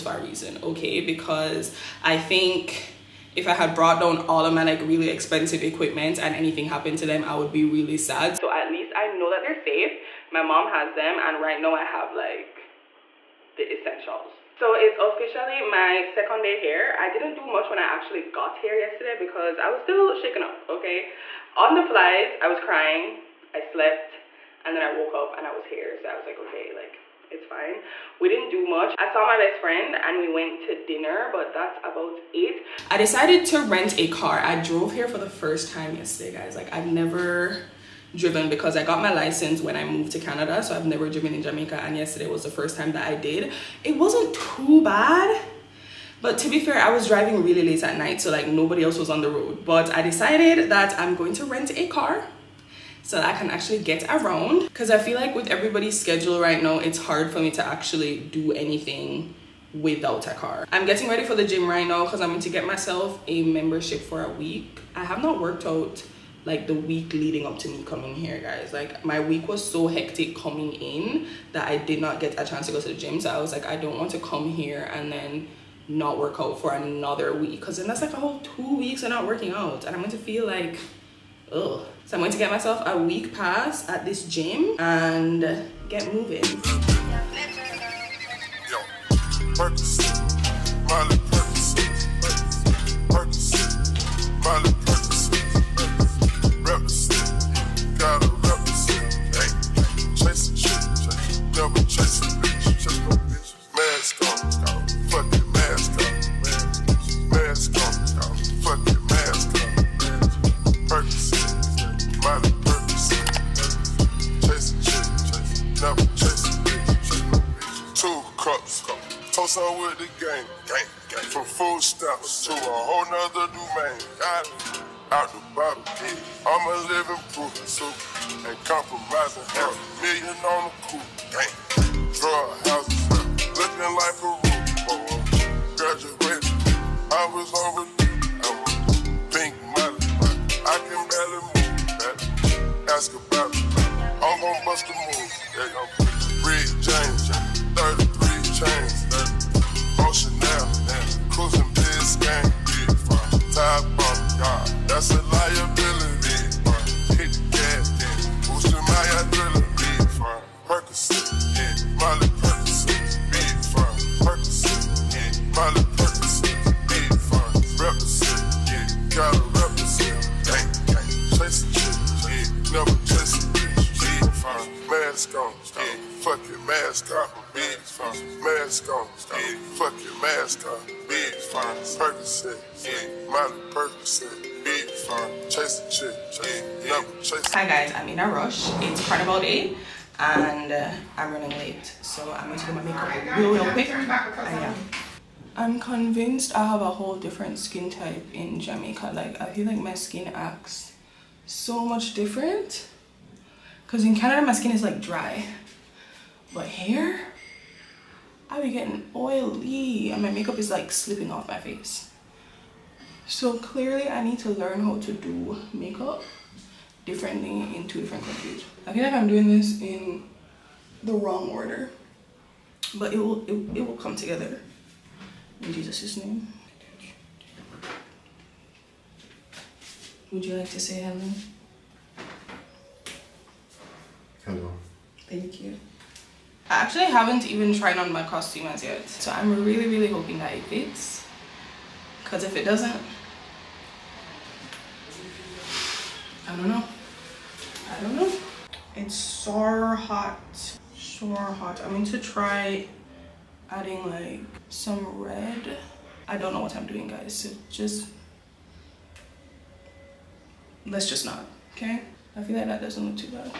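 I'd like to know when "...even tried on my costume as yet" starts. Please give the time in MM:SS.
03:57.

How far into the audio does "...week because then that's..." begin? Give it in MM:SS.
01:17.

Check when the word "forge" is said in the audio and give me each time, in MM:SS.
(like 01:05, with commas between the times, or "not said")
not said.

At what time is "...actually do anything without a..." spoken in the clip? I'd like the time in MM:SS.
00:57.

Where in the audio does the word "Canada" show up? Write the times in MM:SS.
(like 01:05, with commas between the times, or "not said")
00:40, 03:24.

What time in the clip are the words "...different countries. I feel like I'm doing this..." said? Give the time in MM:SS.
03:38.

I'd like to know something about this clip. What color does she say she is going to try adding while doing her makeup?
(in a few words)
Red.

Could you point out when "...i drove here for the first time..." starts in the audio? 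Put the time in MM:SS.
00:34.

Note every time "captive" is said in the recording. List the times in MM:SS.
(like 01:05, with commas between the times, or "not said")
not said.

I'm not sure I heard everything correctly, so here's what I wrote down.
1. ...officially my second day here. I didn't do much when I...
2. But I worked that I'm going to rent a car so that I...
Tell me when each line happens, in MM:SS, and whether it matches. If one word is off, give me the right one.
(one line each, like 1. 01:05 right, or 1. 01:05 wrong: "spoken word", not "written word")
1. 00:14 right
2. 00:49 wrong: "decided", not "worked".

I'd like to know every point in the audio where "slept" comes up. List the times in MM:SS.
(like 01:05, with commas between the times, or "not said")
00:23.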